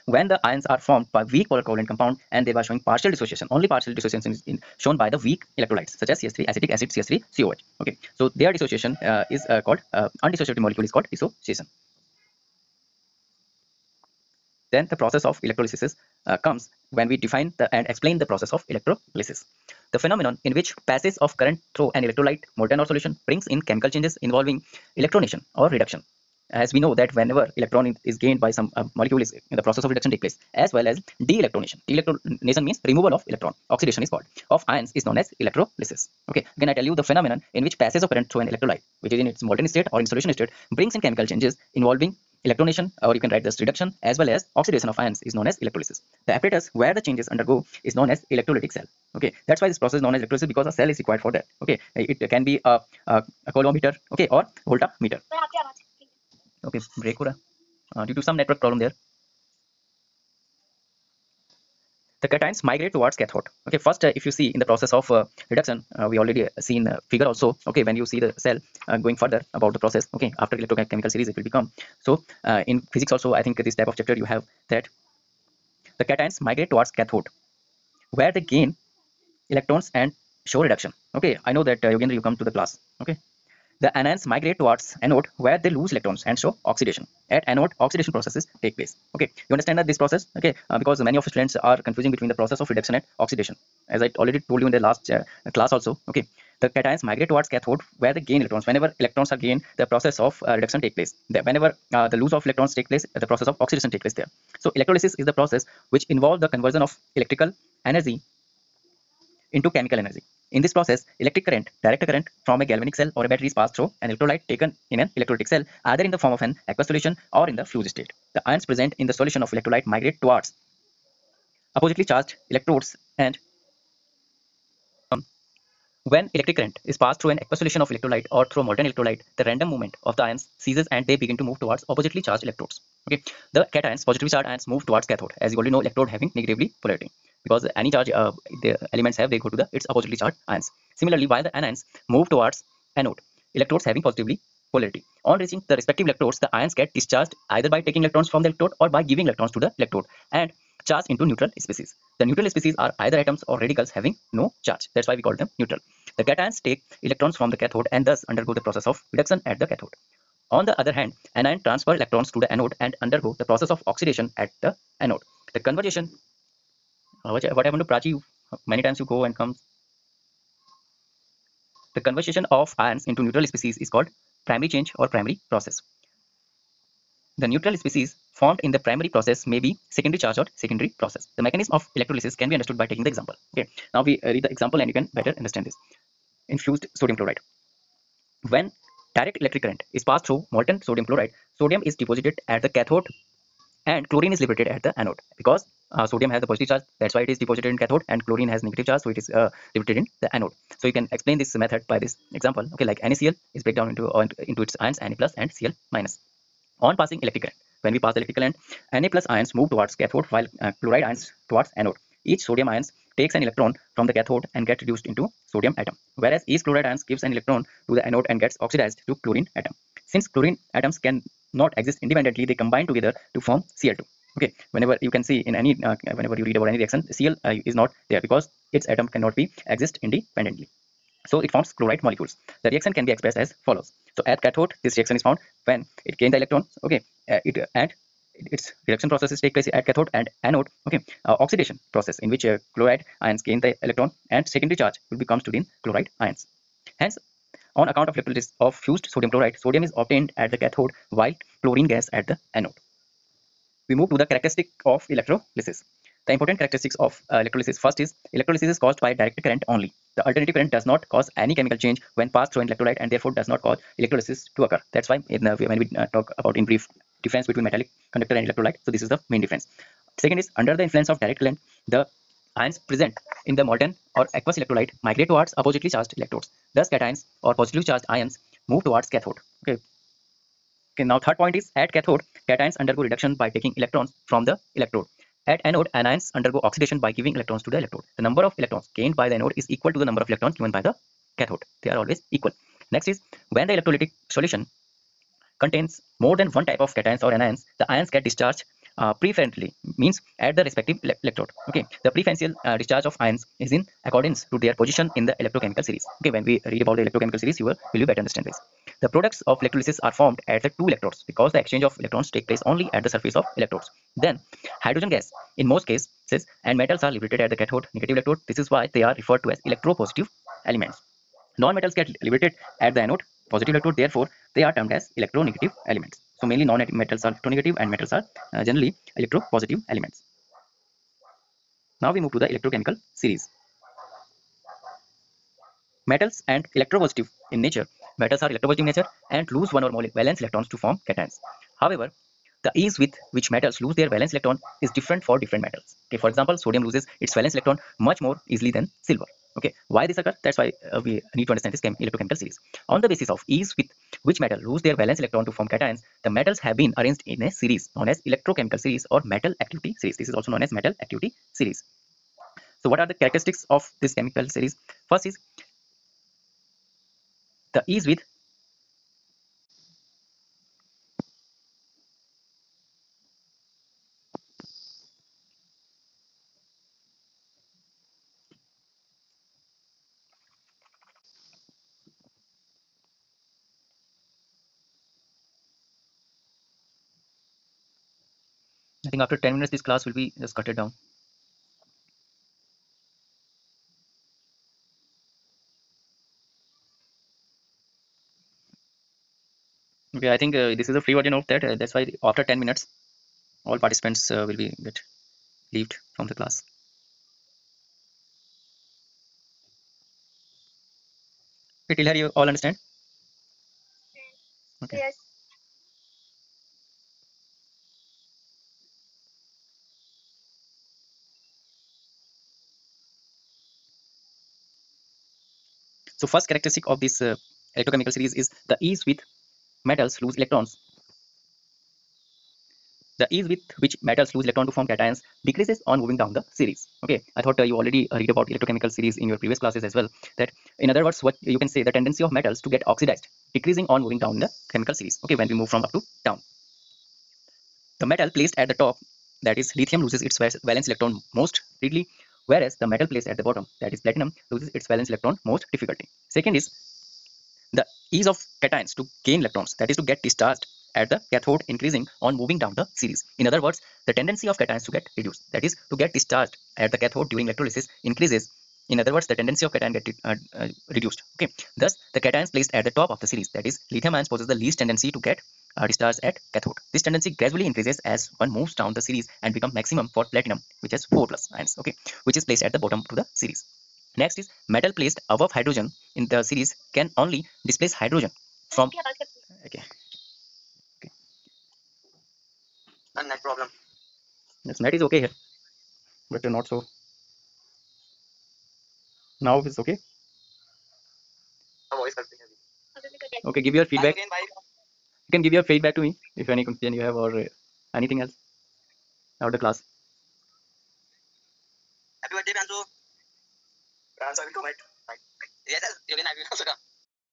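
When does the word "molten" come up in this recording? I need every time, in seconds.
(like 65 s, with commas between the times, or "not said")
22 s, 39 s, 128 s, 190 s, 273 s.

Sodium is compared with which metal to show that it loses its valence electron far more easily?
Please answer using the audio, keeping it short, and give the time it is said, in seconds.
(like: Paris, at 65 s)
silver, at 349 s.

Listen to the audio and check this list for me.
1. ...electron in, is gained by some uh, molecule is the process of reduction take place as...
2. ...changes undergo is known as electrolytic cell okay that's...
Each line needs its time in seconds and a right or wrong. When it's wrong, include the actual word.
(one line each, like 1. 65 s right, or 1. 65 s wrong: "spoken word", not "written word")
1. 27 s right
2. 47 s right.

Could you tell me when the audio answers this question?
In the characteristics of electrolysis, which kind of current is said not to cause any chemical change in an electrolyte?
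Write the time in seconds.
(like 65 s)
260 s.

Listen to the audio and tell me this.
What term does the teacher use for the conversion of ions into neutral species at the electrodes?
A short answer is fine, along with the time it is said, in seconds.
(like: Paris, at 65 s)
primary change, at 174 s.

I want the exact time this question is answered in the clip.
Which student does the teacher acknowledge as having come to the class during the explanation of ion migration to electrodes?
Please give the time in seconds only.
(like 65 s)
81 s.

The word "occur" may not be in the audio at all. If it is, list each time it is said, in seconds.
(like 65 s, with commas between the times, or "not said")
264 s, 350 s.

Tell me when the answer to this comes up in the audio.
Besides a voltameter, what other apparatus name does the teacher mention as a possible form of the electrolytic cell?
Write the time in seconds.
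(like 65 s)
53 s.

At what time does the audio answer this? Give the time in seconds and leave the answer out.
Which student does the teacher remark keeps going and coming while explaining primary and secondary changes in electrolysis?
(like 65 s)
167 s.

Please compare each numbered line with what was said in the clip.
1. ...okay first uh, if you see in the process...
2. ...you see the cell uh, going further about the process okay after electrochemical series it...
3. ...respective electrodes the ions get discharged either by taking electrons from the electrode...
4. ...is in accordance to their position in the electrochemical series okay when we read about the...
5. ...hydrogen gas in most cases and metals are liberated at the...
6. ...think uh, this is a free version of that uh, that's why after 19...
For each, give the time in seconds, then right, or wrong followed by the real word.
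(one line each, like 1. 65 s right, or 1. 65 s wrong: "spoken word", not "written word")
1. 63 s right
2. 67 s right
3. 145 s right
4. 303 s right
5. 314 s right
6. 400 s wrong: "10", not "19".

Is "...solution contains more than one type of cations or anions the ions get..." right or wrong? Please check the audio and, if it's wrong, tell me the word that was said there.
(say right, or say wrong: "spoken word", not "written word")
right.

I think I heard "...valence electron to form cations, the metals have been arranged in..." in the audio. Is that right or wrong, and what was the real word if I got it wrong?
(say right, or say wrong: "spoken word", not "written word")
right.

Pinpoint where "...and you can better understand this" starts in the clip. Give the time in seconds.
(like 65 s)
184 s.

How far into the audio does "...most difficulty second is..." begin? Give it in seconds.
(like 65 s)
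455 s.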